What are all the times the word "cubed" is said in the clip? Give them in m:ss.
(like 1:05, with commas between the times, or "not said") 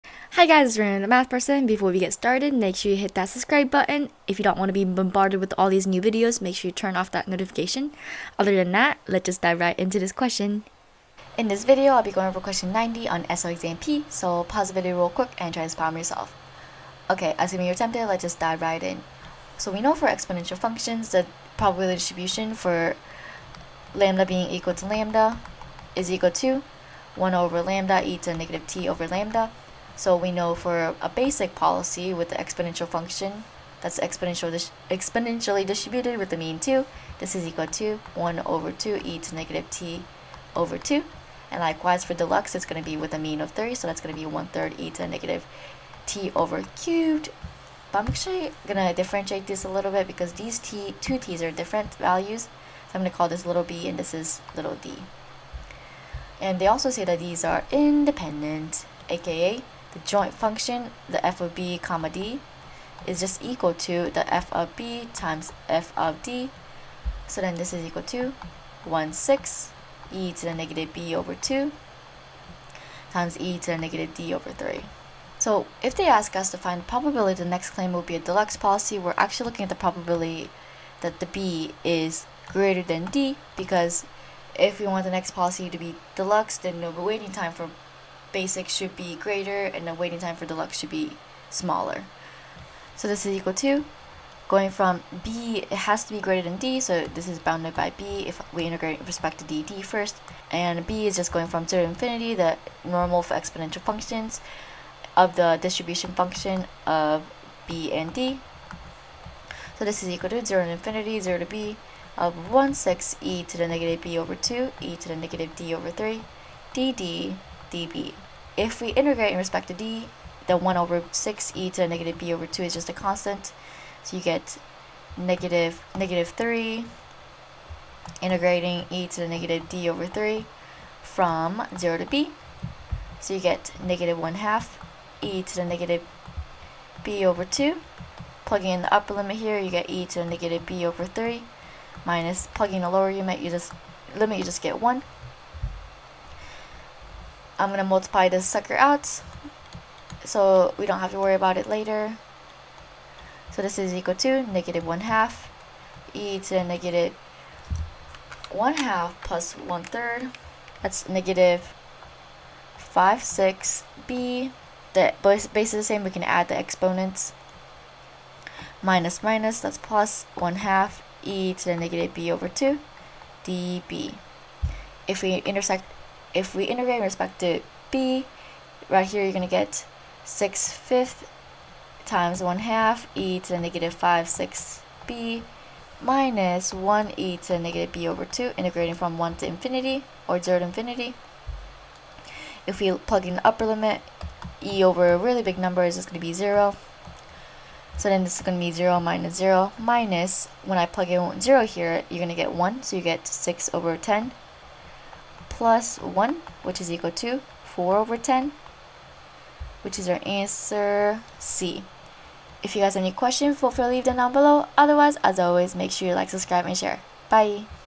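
0:46.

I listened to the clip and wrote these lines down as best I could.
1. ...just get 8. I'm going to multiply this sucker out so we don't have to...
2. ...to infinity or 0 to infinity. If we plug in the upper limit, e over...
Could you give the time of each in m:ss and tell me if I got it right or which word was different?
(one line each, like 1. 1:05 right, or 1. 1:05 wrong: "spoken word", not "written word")
1. 2:24 wrong: "1", not "8"
2. 3:09 right.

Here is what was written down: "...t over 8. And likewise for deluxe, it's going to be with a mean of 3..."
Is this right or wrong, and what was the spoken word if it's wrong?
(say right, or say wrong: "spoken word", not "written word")
wrong: "2", not "8".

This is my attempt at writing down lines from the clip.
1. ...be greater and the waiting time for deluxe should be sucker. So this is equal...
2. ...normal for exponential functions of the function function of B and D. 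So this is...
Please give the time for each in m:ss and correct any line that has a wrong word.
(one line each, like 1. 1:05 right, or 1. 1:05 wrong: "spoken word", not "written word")
1. 1:28 wrong: "smaller", not "sucker"
2. 1:42 wrong: "distribution", not "function".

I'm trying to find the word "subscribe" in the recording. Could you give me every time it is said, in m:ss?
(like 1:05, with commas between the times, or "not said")
0:03, 3:36.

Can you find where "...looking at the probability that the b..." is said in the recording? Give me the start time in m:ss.
1:19.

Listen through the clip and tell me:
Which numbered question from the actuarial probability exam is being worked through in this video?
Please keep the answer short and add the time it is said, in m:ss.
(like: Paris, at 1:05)
90, at 0:12.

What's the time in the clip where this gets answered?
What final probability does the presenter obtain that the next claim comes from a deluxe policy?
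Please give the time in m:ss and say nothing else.
3:27.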